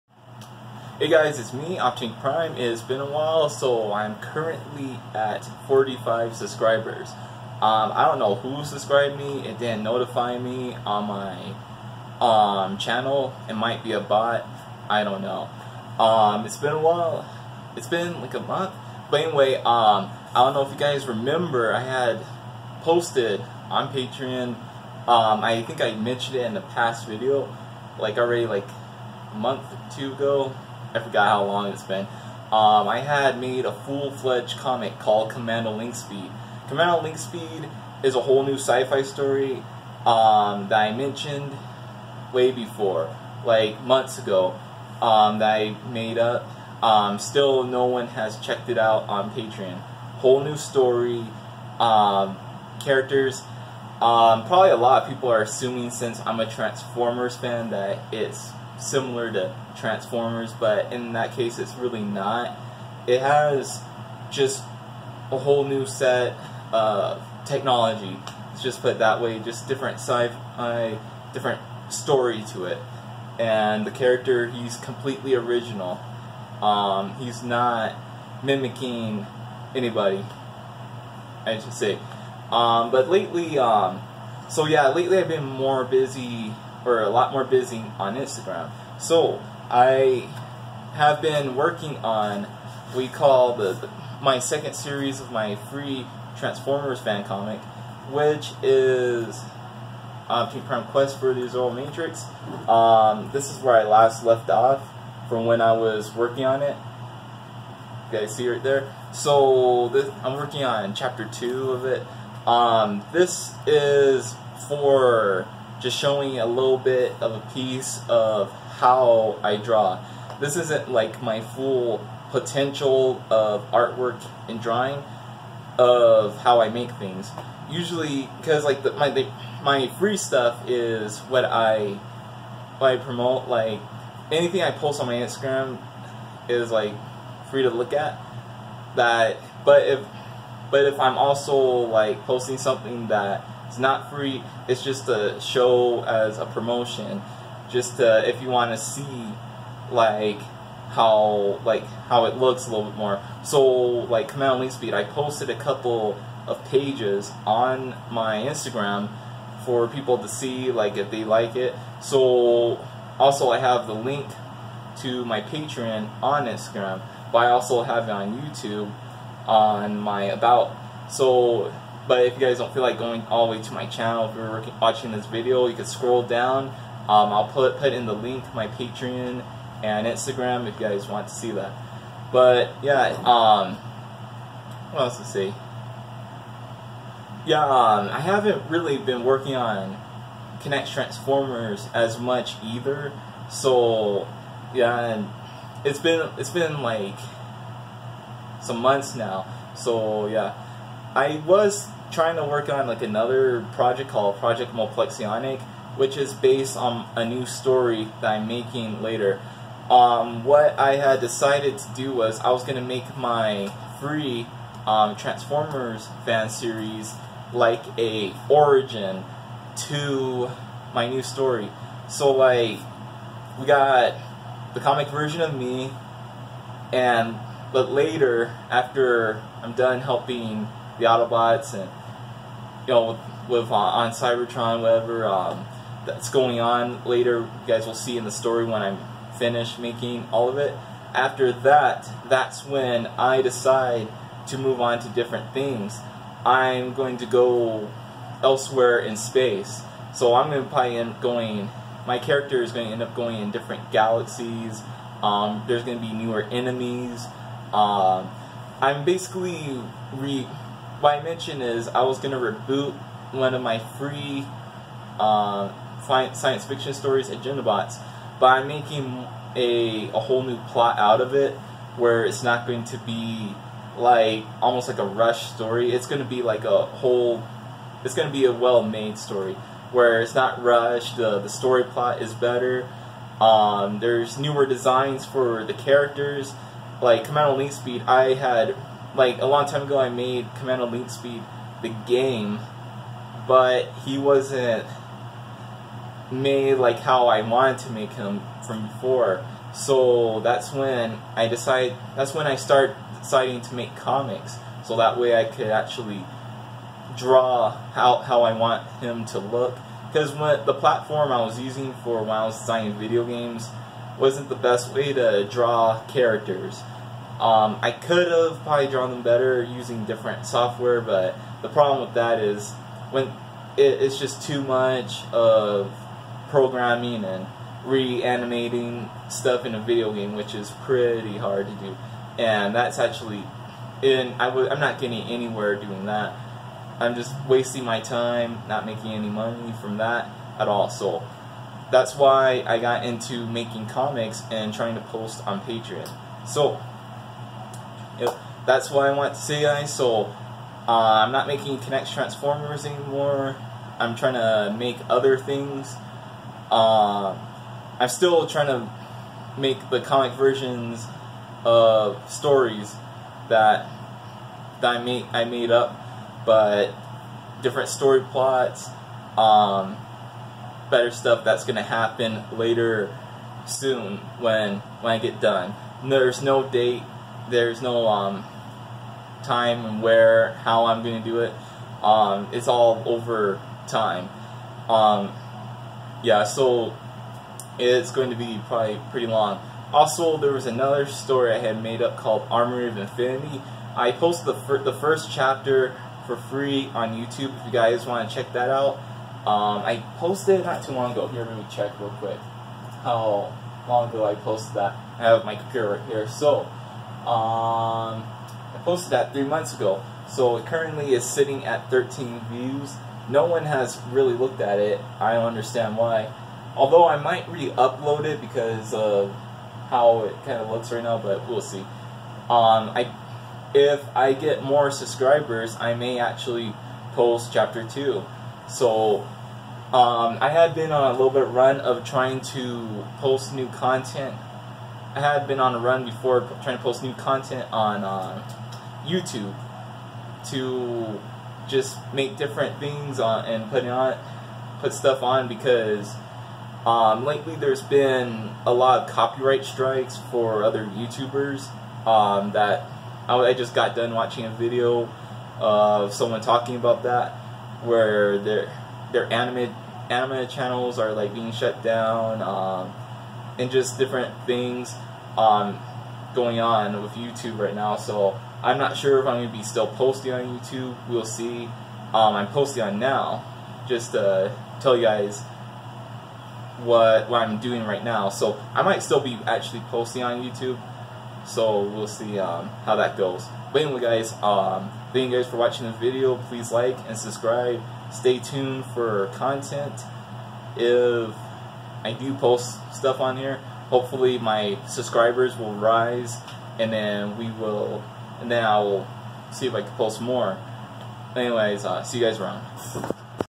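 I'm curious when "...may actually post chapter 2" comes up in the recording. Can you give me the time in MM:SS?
07:05.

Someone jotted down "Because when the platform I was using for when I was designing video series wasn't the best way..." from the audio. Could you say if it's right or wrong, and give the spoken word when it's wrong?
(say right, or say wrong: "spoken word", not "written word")
wrong: "games", not "series".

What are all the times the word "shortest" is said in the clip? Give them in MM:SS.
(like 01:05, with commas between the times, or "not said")
not said.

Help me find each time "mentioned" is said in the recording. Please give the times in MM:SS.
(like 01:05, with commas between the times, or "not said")
00:25, 00:40, 04:21.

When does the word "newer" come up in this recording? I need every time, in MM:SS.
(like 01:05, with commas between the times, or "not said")
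04:16, 04:44.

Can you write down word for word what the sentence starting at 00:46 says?
Um, still, no one has checked it out on Patreon.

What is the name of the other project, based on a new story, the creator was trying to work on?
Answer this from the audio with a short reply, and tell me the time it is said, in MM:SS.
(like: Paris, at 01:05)
Project Mulplexionick, at 03:24.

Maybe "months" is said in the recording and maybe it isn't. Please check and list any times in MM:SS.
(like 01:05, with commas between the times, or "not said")
00:18, 00:29, 00:43, 03:18, 06:49.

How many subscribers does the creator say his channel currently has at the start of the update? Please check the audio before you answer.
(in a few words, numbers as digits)
45.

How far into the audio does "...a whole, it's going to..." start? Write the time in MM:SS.
04:36.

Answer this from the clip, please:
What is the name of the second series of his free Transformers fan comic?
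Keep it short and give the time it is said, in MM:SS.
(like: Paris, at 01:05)
Prime Quest for the Zero Matrix, at 01:40.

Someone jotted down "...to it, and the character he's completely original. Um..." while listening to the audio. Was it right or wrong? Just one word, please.
right.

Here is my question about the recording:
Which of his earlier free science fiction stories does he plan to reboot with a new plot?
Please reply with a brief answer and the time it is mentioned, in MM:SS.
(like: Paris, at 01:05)
Agenda Bots, at 04:27.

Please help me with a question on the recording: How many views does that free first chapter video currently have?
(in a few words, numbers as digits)
13.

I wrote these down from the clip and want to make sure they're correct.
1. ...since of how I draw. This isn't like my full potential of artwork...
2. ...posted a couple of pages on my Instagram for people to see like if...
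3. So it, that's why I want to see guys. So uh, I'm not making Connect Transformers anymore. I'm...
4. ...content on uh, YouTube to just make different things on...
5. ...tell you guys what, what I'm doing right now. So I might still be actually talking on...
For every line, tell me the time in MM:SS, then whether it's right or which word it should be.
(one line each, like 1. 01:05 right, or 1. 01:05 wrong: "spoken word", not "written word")
1. 01:57 wrong: "piece", not "since"
2. 02:35 right
3. 05:46 right
4. 07:17 right
5. 07:54 wrong: "posting", not "talking".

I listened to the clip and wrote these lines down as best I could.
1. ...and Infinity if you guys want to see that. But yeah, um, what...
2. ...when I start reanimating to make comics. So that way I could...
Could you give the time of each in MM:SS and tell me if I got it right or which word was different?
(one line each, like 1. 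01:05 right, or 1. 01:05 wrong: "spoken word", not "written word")
1. 02:59 wrong: "Instagram", not "Infinity"
2. 05:02 wrong: "deciding", not "reanimating".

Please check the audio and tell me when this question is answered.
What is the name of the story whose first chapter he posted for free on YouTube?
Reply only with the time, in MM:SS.
06:32.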